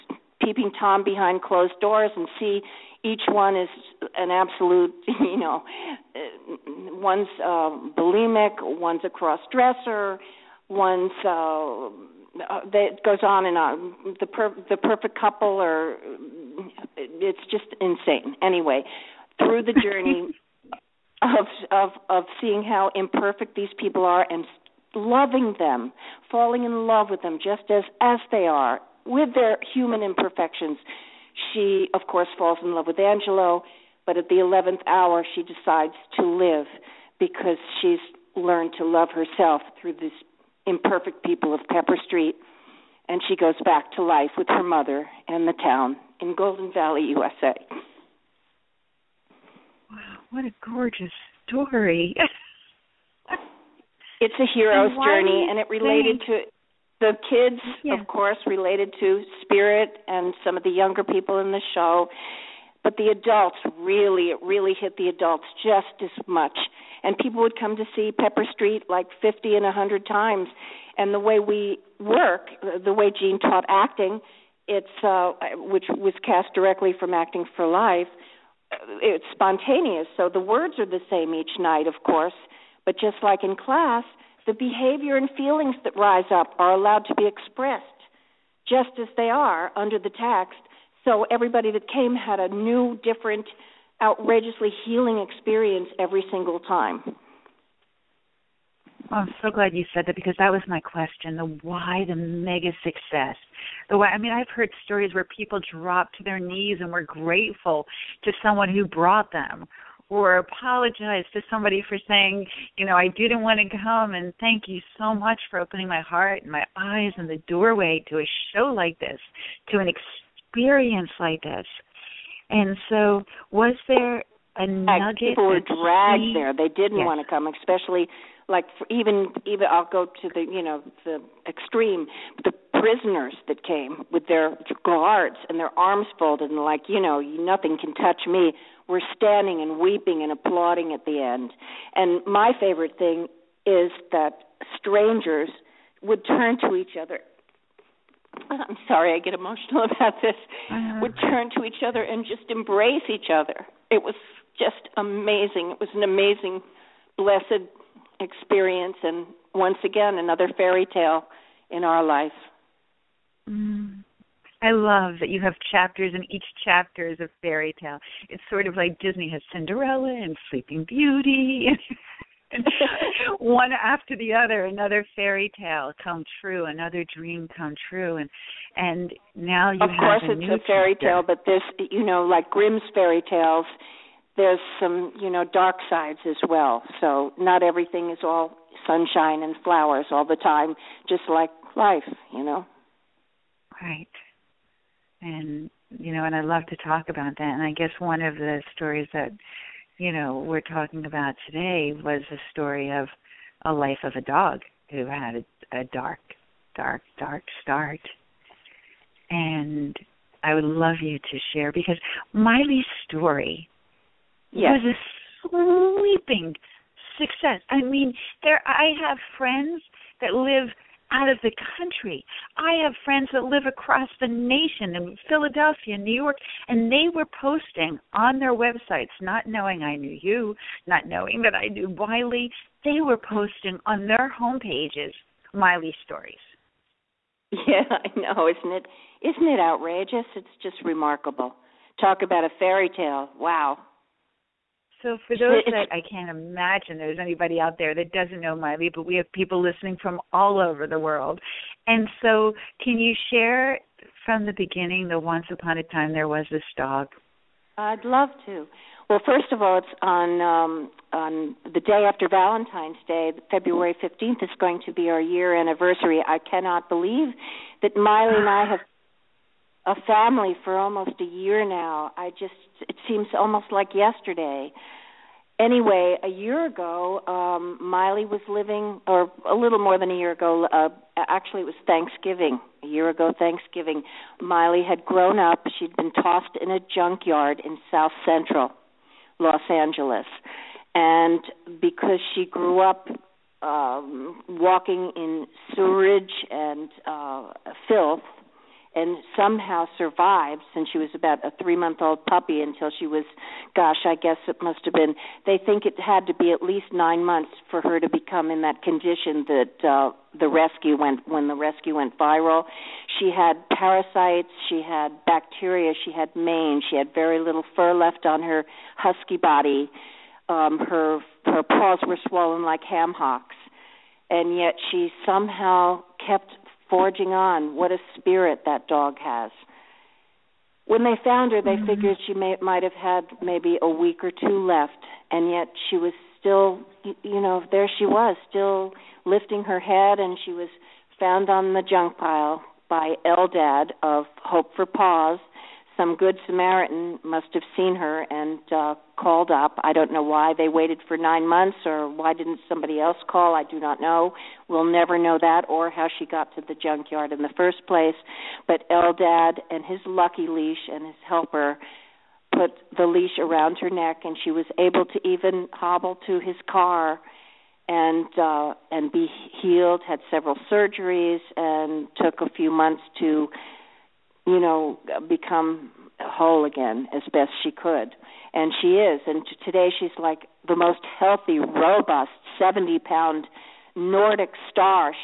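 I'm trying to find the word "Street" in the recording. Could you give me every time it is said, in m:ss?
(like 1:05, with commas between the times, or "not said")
0:42, 1:08.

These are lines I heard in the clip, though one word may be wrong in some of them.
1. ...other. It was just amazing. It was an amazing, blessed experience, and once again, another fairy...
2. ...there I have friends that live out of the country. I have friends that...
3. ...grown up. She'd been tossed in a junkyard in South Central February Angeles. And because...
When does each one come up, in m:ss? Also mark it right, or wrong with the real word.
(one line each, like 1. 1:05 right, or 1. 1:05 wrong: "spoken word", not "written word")
1. 2:33 right
2. 3:38 right
3. 4:45 wrong: "Los", not "February".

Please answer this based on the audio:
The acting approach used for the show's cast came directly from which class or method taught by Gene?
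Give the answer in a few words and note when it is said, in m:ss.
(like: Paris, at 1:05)
Acting for Life, at 1:17.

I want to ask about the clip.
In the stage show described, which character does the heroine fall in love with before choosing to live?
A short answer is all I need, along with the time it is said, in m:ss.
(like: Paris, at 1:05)
Angelo, at 0:32.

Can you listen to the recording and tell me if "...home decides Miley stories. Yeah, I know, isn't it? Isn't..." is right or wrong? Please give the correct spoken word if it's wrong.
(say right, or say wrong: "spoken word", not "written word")
wrong: "pages", not "decides".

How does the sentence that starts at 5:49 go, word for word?
I don't know why they waited for nine months or why didn't somebody else call.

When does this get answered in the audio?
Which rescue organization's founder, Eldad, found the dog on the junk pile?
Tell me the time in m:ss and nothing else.
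5:44.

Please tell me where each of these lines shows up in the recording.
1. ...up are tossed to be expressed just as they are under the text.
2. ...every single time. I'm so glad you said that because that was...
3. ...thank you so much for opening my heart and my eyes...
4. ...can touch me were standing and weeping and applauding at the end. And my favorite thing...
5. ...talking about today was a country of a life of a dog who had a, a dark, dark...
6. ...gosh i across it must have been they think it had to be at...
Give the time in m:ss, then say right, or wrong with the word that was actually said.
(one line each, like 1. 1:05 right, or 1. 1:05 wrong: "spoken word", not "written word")
1. 1:26 wrong: "allowed", not "tossed"
2. 1:35 right
3. 1:54 right
4. 2:17 right
5. 3:20 wrong: "story", not "country"
6. 5:03 wrong: "guess", not "across".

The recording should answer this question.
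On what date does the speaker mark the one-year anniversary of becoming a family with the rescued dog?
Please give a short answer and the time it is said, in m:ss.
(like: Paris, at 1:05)
February 15, at 4:23.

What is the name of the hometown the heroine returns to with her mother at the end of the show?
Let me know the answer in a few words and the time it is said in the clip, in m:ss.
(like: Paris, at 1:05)
Golden Valley, at 0:46.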